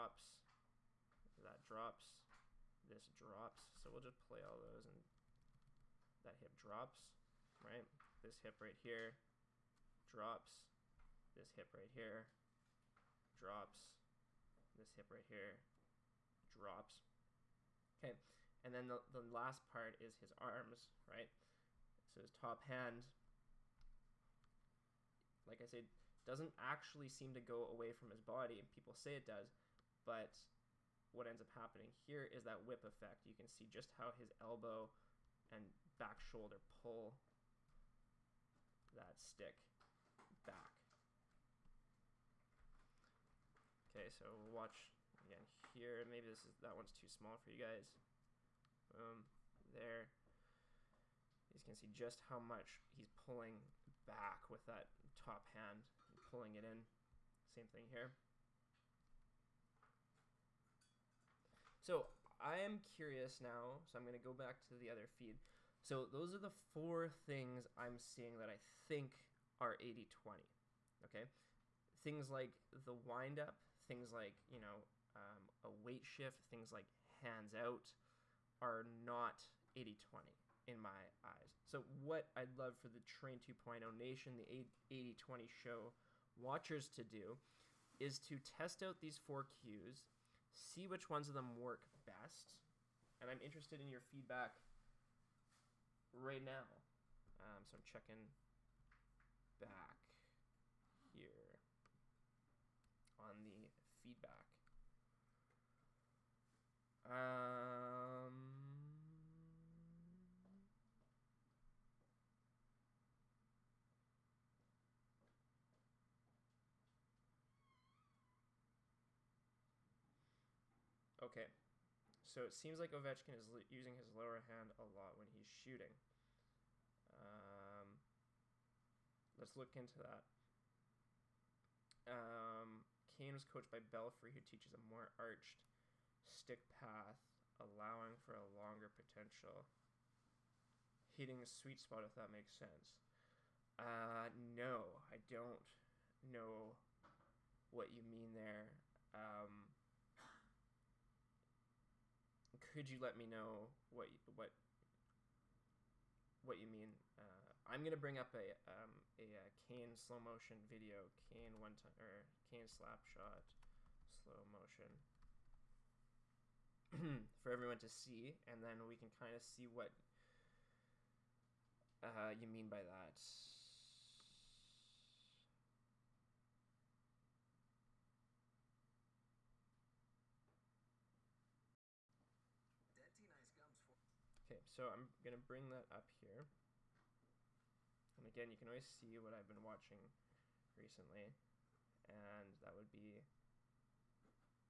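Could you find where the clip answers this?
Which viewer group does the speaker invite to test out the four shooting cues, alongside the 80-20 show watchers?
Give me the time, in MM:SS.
01:22.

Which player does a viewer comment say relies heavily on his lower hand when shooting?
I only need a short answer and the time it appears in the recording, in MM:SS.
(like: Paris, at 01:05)
Ovechkin, at 02:02.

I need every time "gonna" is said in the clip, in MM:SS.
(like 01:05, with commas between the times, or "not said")
02:37.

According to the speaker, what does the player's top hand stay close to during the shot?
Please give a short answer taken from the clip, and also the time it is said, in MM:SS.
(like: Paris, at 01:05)
His body, at 00:28.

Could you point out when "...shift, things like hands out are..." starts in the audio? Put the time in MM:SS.
01:16.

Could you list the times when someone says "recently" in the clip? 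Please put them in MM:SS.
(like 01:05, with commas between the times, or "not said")
03:10.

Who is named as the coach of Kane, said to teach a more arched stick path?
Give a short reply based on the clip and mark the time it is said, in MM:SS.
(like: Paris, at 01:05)
Belfry, at 02:13.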